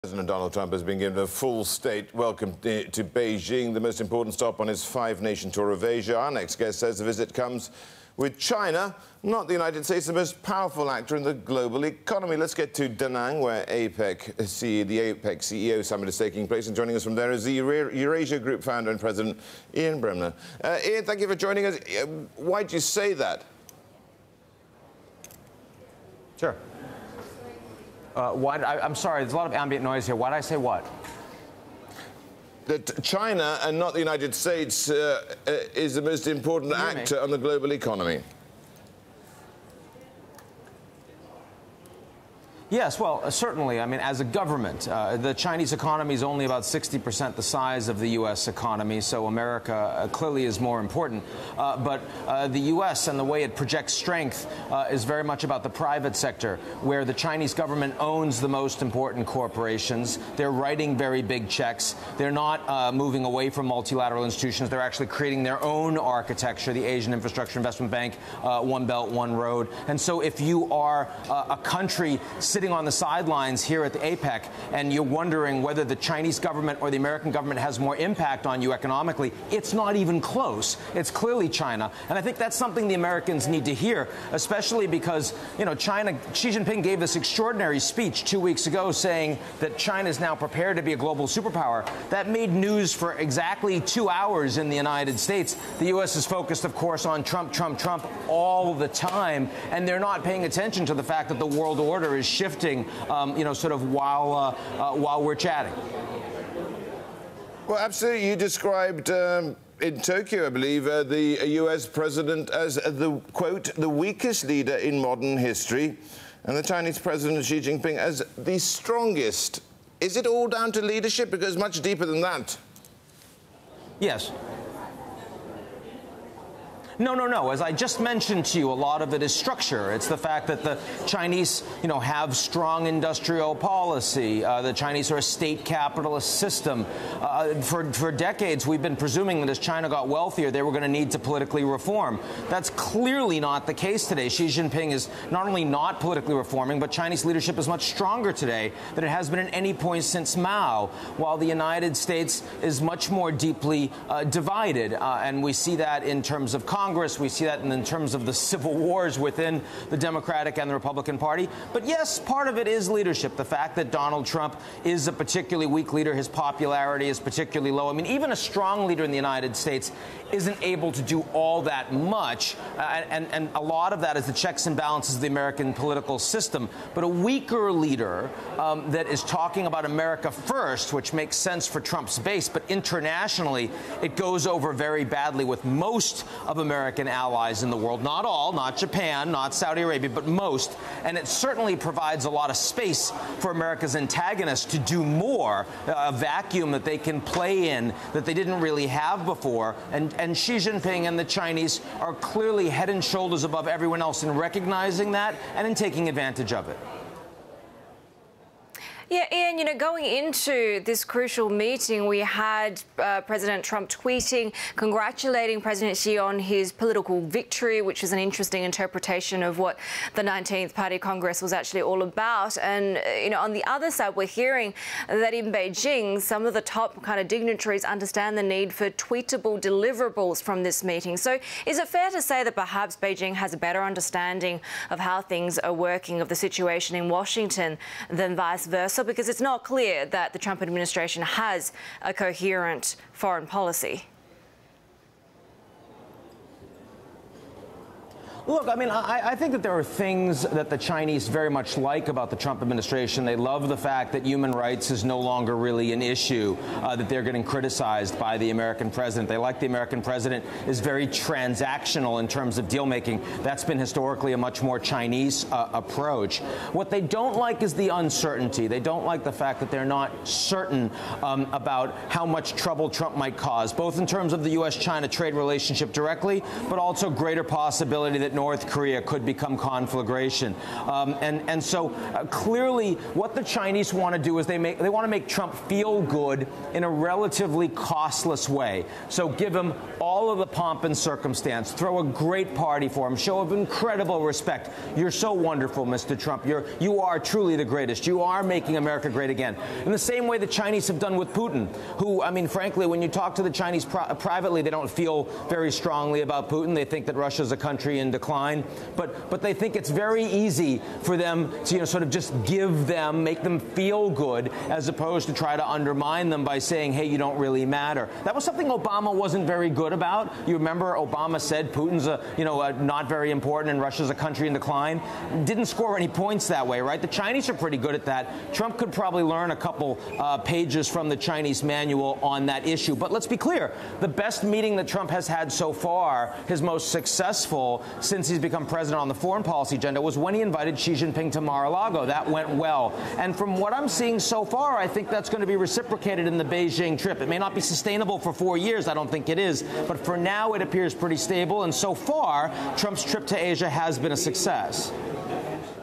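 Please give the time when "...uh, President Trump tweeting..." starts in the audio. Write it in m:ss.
3:32.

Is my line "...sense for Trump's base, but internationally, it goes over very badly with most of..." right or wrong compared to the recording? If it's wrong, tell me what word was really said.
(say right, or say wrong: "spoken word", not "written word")
right.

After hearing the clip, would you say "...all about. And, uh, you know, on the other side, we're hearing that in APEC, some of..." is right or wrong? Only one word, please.
wrong.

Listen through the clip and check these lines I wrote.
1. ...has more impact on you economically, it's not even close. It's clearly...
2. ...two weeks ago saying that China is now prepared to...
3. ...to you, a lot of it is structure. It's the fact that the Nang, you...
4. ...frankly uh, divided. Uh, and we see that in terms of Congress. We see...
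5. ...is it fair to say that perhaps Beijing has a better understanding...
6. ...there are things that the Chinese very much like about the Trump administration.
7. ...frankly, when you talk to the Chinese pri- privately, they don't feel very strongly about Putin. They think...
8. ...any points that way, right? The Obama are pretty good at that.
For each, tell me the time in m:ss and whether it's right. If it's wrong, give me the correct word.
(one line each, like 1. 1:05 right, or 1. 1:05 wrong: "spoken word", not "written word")
1. 1:17 right
2. 1:28 right
3. 2:08 wrong: "Chinese", not "Nang"
4. 2:33 wrong: "deeply", not "frankly"
5. 3:51 right
6. 4:09 right
7. 5:02 right
8. 5:25 wrong: "Chinese", not "Obama".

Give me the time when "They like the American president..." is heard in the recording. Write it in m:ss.
4:19.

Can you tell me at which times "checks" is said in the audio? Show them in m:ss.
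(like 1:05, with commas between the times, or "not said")
1:01, 2:54.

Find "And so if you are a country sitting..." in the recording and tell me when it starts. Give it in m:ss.
1:09.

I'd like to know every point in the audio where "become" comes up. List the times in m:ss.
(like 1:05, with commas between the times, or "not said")
4:39, 5:38.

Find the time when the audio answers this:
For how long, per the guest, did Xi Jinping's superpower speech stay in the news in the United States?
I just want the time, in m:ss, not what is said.
1:33.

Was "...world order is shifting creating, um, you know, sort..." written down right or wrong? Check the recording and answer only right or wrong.
wrong.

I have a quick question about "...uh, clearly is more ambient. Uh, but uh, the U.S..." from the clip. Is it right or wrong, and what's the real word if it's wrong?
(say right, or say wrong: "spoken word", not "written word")
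wrong: "important", not "ambient".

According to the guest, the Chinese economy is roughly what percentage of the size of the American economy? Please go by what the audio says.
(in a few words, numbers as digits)
60%.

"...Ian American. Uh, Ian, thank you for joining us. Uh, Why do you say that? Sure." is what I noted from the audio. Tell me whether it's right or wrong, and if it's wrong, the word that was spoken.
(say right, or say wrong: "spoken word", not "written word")
wrong: "Bremmer", not "American".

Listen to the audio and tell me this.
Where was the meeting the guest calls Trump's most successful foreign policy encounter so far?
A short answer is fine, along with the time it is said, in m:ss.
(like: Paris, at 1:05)
Mar-a-Lago, at 5:41.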